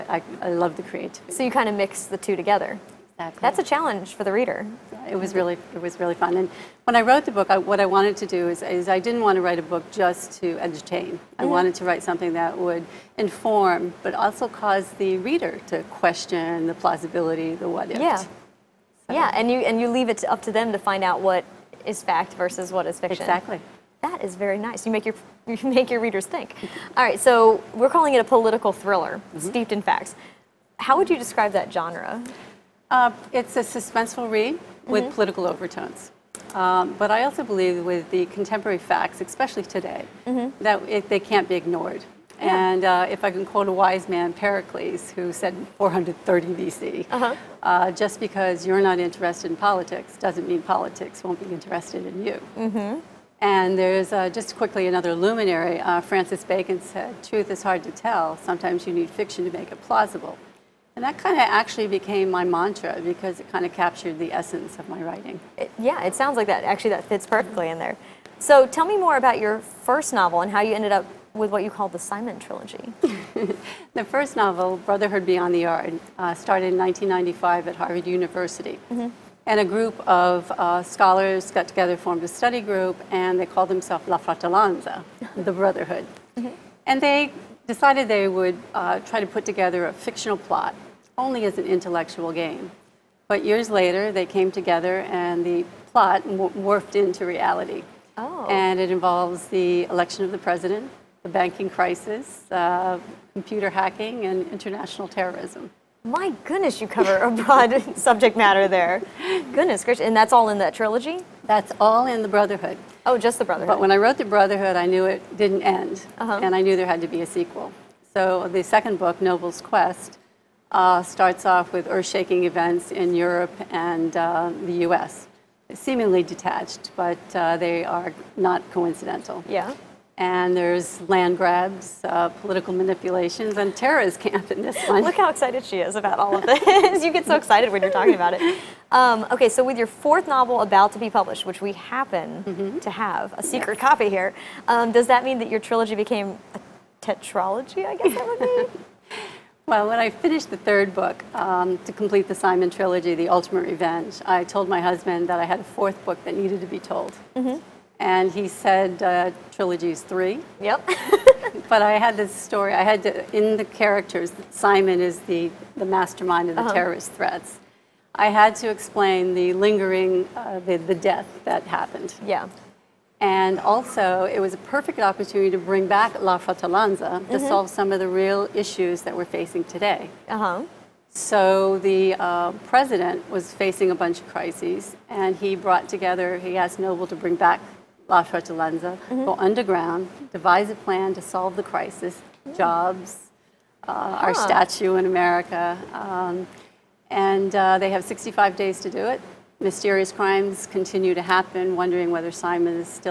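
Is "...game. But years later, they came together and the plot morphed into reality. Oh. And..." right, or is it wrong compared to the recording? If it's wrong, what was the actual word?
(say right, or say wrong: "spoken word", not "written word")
right.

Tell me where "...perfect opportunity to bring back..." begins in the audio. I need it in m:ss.
2:54.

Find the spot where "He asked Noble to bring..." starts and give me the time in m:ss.
3:06.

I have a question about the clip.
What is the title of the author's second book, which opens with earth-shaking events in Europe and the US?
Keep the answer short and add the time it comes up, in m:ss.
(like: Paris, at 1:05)
Noble's Quest, at 1:59.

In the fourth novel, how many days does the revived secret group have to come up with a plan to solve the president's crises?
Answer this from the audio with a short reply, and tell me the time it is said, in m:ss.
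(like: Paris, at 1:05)
65, at 3:18.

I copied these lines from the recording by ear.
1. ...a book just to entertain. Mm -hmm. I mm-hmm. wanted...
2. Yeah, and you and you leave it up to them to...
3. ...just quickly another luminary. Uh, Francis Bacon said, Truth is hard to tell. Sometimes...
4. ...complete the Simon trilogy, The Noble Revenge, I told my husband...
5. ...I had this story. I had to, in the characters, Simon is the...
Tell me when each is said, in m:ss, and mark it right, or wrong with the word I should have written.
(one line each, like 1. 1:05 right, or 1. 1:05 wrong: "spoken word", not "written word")
1. 0:09 right
2. 0:19 right
3. 0:54 right
4. 2:31 wrong: "Ultimate", not "Noble"
5. 2:41 right.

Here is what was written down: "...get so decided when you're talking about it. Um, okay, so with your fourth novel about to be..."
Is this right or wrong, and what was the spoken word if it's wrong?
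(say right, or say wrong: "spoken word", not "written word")
wrong: "excited", not "decided".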